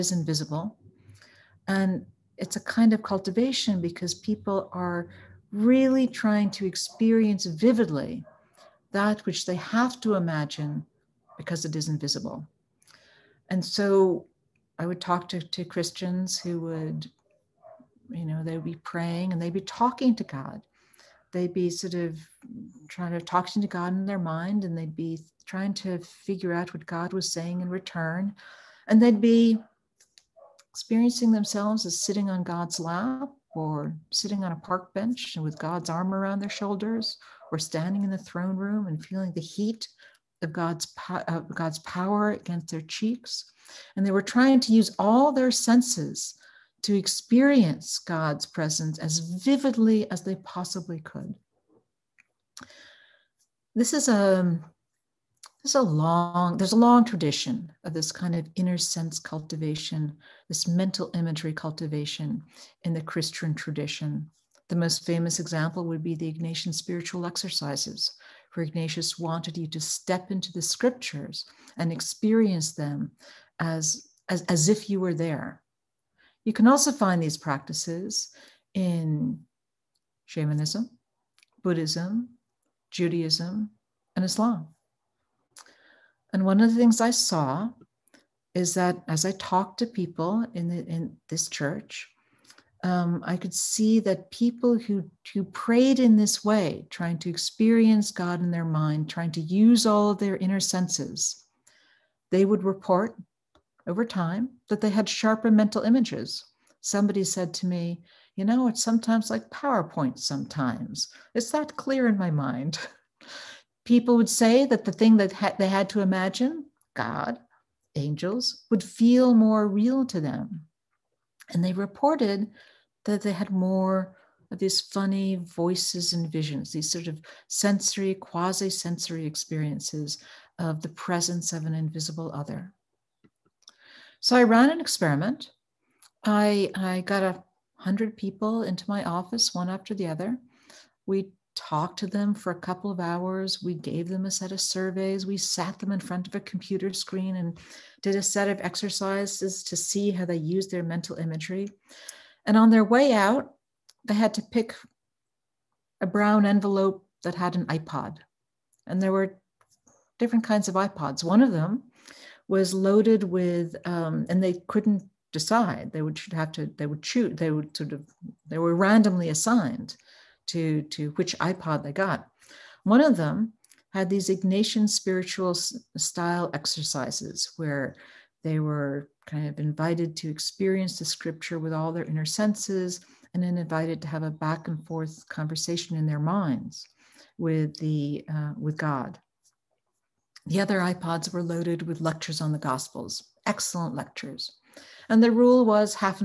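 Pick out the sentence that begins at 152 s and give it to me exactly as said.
And on their way out, they had to pick a brown envelope that had an iPod.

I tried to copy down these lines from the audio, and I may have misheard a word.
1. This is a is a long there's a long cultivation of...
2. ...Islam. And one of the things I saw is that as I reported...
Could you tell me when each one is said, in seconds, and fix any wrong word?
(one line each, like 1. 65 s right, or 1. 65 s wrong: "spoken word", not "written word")
1. 53 s wrong: "tradition", not "cultivation"
2. 84 s wrong: "talked", not "reported".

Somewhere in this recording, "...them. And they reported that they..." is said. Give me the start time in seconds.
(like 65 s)
120 s.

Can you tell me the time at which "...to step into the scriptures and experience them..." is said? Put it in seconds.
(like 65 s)
69 s.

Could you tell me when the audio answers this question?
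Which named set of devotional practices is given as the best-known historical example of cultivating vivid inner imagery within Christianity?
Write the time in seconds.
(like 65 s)
66 s.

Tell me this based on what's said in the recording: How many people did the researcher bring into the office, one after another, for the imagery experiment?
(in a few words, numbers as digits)
100.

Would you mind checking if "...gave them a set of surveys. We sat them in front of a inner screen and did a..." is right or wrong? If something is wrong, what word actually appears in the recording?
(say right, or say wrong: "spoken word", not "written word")
wrong: "computer", not "inner".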